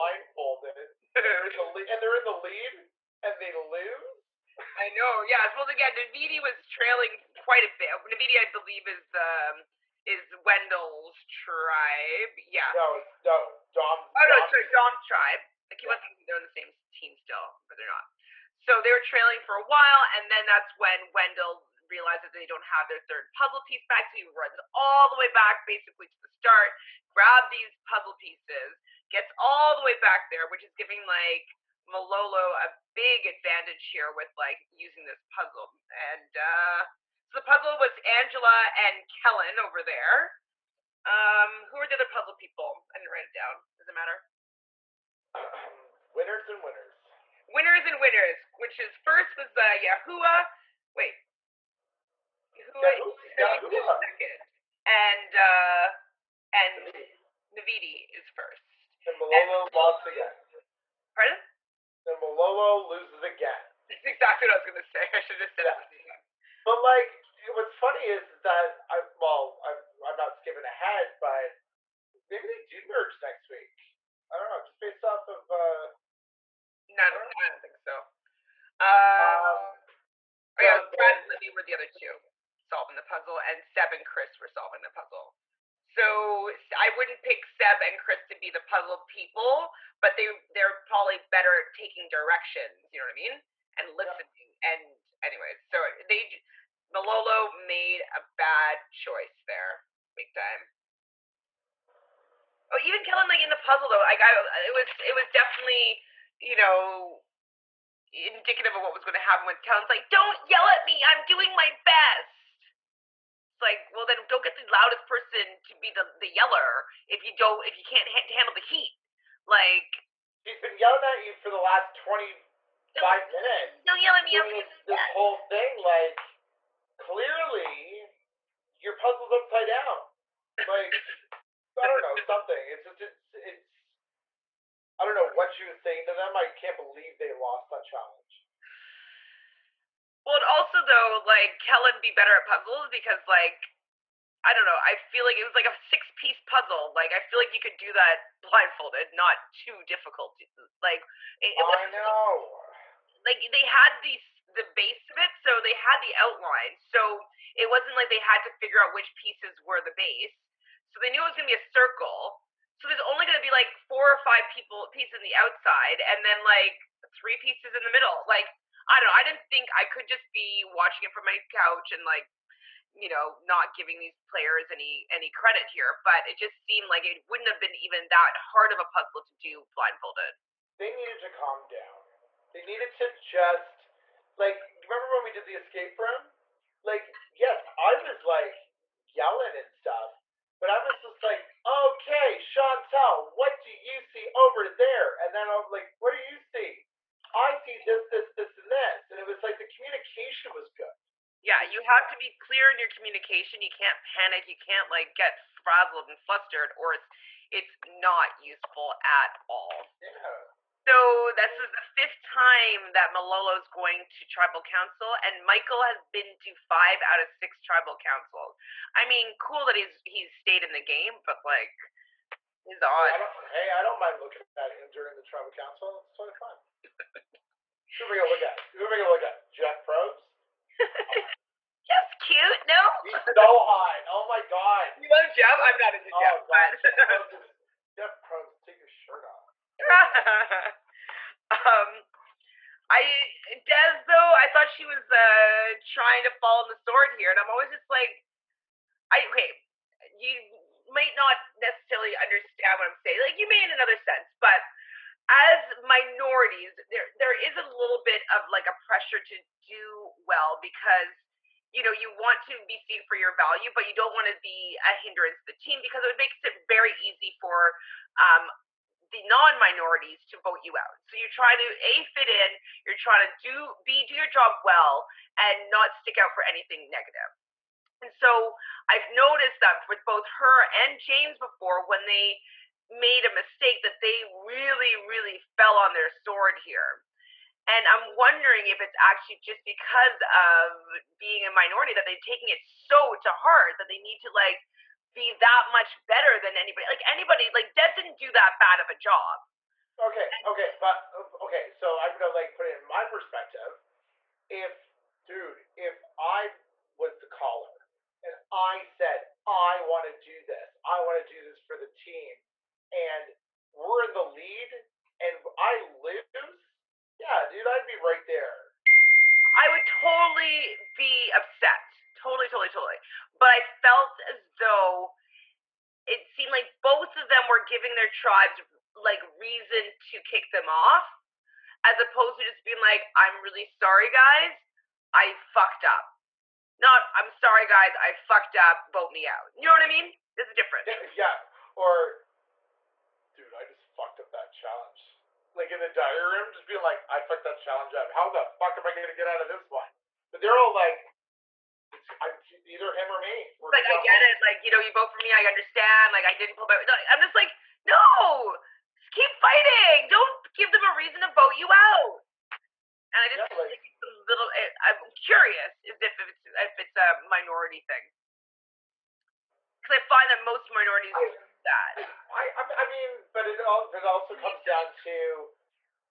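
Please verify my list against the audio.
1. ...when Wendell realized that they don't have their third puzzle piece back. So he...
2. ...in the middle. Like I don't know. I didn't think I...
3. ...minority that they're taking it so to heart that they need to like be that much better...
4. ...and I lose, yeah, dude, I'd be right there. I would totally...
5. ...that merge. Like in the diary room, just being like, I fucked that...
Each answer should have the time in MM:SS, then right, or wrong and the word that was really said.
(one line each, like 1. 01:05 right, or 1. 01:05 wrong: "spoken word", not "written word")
1. 00:20 right
2. 02:47 right
3. 04:51 right
4. 05:15 right
5. 05:44 wrong: "challenge", not "merge".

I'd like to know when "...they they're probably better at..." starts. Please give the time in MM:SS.
01:30.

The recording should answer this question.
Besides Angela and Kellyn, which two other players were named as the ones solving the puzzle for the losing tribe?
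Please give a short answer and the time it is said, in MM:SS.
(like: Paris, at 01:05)
Brad and Libby, at 01:20.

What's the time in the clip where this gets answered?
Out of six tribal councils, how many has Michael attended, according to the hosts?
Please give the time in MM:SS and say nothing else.
03:36.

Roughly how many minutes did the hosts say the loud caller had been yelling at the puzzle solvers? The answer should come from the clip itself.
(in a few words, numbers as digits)
25.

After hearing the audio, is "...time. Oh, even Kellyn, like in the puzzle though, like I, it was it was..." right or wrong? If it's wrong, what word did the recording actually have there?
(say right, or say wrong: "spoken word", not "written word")
right.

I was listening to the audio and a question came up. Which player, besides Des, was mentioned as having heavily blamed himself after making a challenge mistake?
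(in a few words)
James.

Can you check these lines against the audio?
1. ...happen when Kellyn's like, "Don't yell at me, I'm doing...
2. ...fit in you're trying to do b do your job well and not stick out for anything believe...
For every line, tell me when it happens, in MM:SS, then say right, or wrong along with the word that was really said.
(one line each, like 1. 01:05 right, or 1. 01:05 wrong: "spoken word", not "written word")
1. 01:49 right
2. 04:32 wrong: "negative", not "believe".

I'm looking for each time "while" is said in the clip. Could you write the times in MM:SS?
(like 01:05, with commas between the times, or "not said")
00:19.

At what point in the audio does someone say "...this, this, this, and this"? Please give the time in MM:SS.
03:17.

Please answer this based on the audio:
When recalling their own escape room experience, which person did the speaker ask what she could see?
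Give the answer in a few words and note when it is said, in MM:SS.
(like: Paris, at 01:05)
Chantel, at 03:12.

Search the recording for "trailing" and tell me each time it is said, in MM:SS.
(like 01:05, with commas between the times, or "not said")
00:06, 00:18.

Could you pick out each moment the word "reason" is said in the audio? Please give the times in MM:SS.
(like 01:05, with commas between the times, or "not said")
05:29, 06:00.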